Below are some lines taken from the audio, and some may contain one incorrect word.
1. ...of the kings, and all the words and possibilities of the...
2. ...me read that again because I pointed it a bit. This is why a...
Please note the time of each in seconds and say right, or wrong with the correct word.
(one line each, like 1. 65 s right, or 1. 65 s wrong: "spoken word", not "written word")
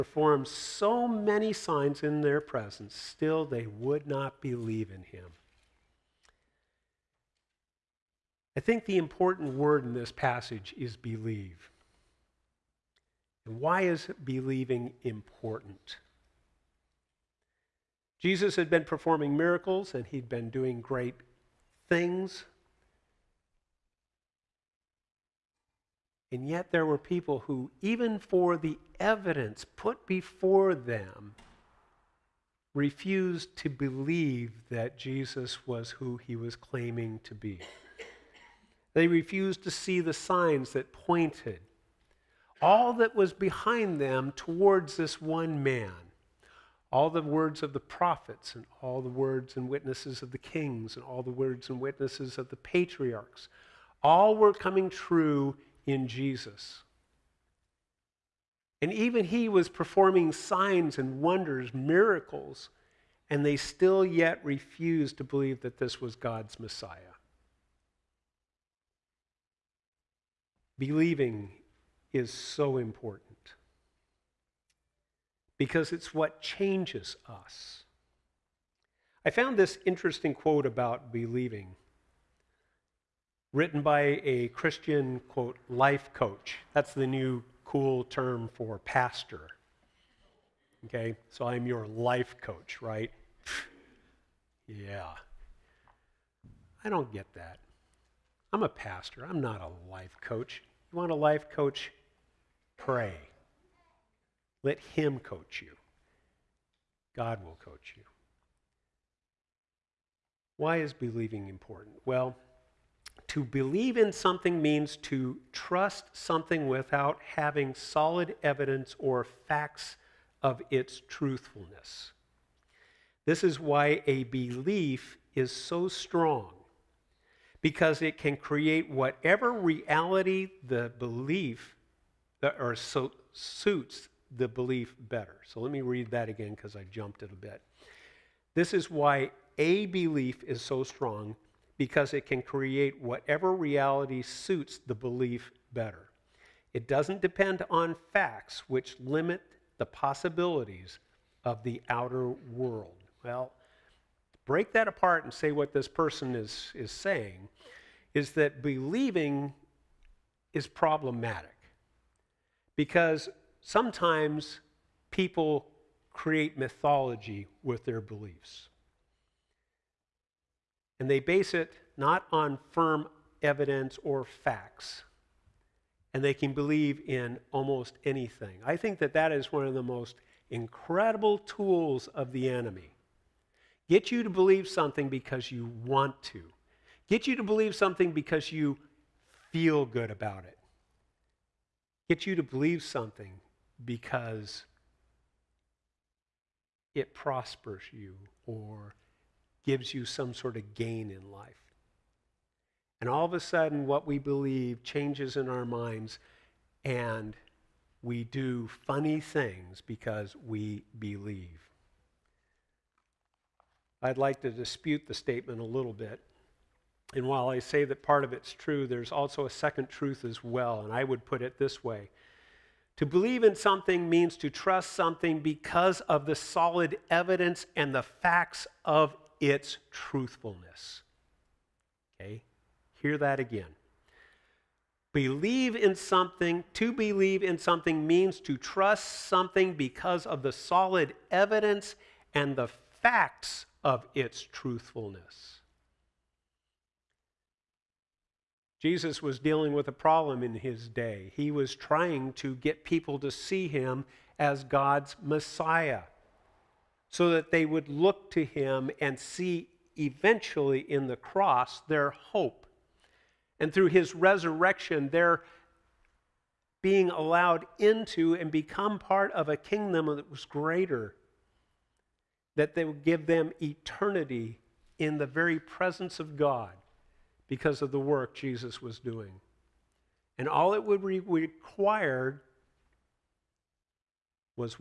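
1. 50 s wrong: "witnesses", not "possibilities"
2. 135 s wrong: "jumped", not "pointed".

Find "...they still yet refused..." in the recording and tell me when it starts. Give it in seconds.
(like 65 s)
63 s.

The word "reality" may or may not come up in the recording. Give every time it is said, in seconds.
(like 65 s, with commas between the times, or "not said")
129 s, 143 s.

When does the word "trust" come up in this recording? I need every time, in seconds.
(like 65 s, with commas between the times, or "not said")
115 s, 224 s, 238 s.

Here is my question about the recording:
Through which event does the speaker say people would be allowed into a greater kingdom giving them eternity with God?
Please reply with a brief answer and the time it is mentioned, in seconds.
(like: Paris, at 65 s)
his resurrection, at 263 s.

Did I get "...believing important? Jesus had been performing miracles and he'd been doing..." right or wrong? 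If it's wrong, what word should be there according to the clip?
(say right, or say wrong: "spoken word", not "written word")
right.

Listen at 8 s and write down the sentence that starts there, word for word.
I think the important word in this passage is believe.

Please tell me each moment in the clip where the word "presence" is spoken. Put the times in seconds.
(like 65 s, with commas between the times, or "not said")
2 s, 275 s.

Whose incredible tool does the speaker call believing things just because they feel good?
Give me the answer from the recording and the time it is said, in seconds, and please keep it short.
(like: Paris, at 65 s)
the enemy, at 182 s.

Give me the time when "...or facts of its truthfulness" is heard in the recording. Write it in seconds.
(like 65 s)
118 s.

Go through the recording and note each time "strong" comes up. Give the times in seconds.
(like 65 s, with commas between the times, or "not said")
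125 s, 140 s.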